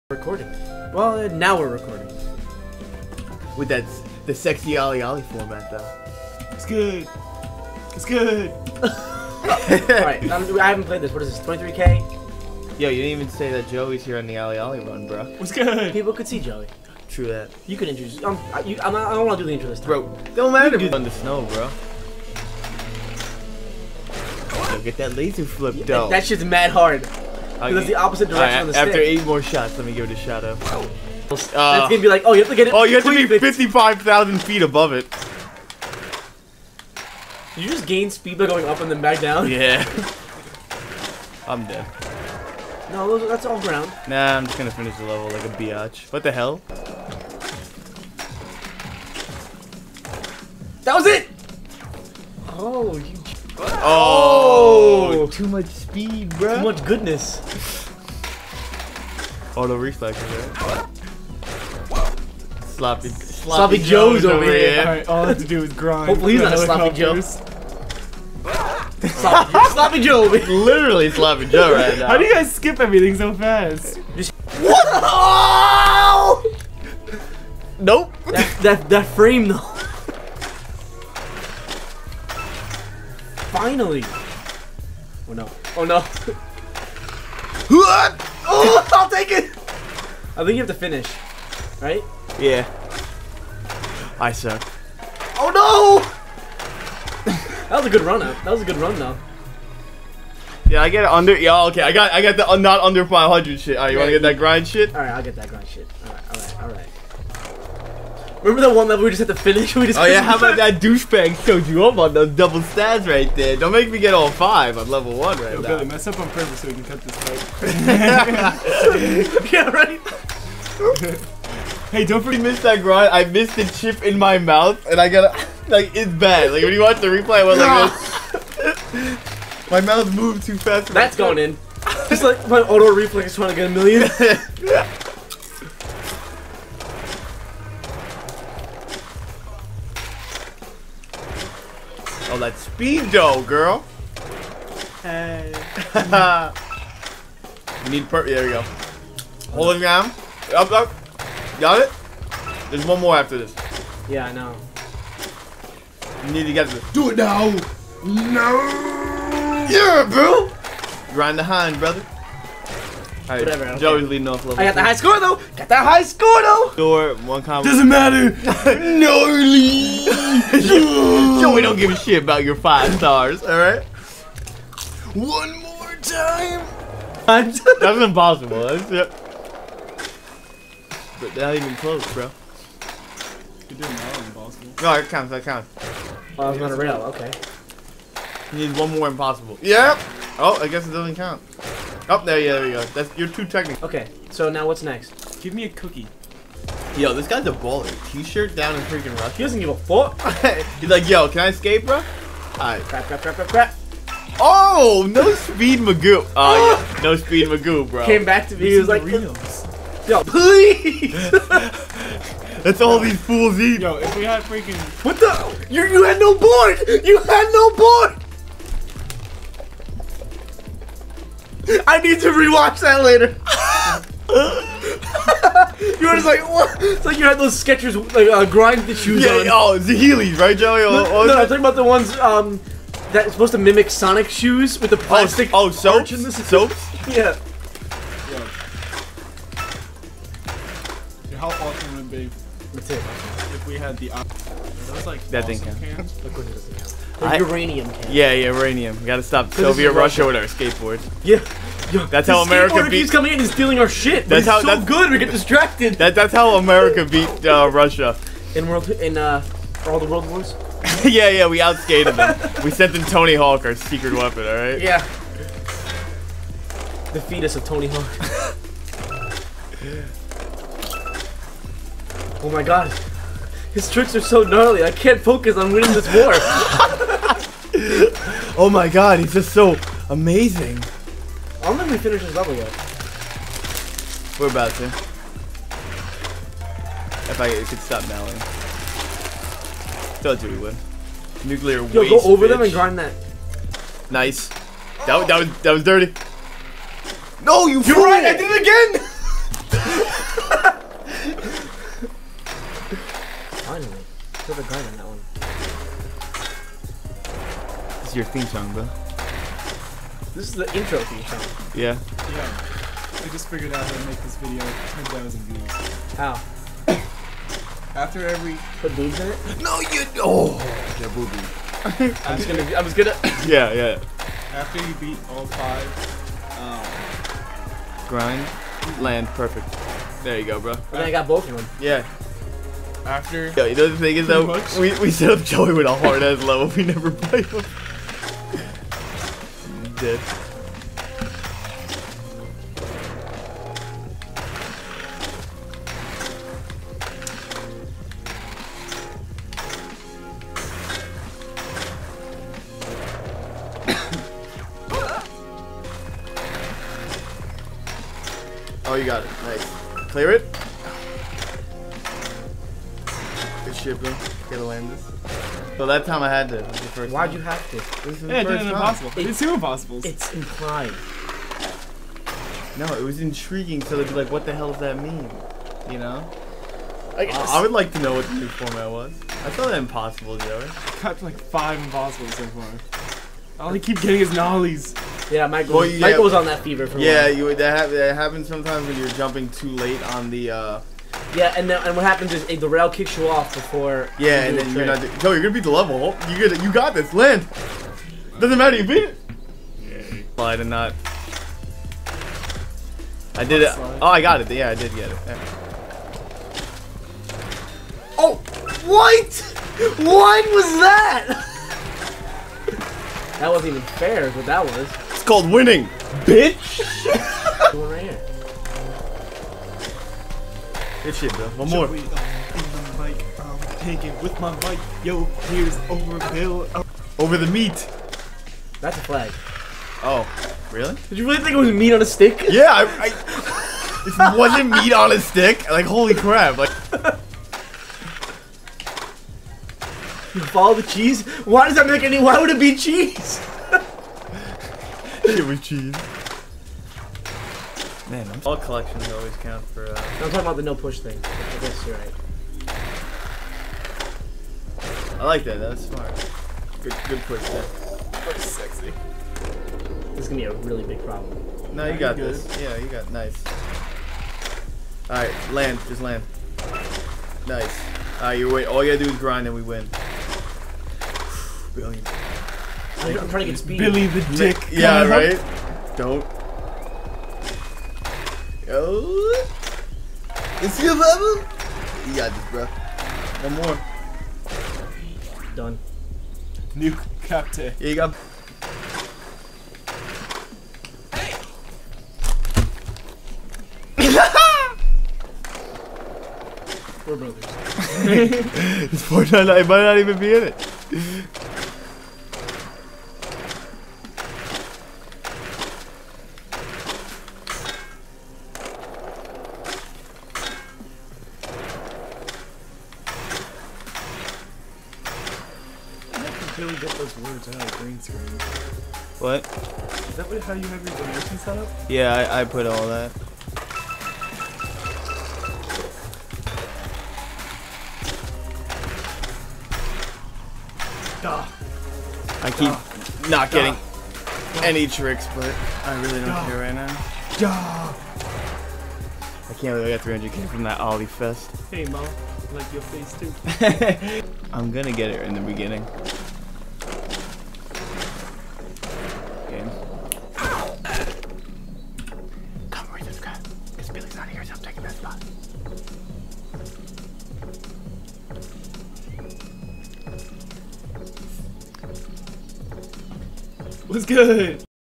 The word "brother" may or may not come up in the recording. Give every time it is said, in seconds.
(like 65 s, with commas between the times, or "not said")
161 s, 497 s.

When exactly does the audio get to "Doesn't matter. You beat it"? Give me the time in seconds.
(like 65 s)
398 s.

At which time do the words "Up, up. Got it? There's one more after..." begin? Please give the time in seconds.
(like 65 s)
150 s.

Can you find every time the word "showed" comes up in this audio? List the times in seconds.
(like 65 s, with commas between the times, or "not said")
111 s.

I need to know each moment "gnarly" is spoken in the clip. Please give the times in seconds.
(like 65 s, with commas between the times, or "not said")
168 s, 274 s.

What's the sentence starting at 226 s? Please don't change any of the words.
It's like you had those Skechers like uh, grind the shoes yeah, on.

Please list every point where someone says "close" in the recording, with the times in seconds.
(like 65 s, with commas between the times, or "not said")
181 s.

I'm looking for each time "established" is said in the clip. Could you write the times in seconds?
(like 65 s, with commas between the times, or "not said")
not said.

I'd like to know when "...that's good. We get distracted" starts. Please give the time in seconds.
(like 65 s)
254 s.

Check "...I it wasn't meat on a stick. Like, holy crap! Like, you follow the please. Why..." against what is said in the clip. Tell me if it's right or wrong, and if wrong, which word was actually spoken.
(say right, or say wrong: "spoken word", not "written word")
wrong: "cheese", not "please".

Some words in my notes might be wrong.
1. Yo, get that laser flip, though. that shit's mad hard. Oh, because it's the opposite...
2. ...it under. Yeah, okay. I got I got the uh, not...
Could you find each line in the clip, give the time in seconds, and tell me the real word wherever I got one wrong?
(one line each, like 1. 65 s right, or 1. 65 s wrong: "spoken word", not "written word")
1. 24 s right
2. 101 s right.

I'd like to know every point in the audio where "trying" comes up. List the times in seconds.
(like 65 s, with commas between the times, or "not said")
133 s, 473 s.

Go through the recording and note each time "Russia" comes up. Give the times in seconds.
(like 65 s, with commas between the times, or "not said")
249 s, 257 s.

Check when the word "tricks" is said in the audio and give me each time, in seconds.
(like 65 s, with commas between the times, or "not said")
273 s, 534 s.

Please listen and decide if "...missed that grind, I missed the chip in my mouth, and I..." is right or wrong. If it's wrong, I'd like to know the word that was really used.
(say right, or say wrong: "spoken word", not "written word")
right.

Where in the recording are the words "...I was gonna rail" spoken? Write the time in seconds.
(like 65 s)
186 s.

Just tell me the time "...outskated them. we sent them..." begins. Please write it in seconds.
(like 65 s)
261 s.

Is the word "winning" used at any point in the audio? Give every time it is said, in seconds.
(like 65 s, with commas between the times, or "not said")
275 s, 415 s.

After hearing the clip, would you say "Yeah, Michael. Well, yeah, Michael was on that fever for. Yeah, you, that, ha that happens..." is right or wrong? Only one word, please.
right.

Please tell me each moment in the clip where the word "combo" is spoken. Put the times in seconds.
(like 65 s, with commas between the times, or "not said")
167 s.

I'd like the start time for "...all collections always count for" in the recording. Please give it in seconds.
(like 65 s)
448 s.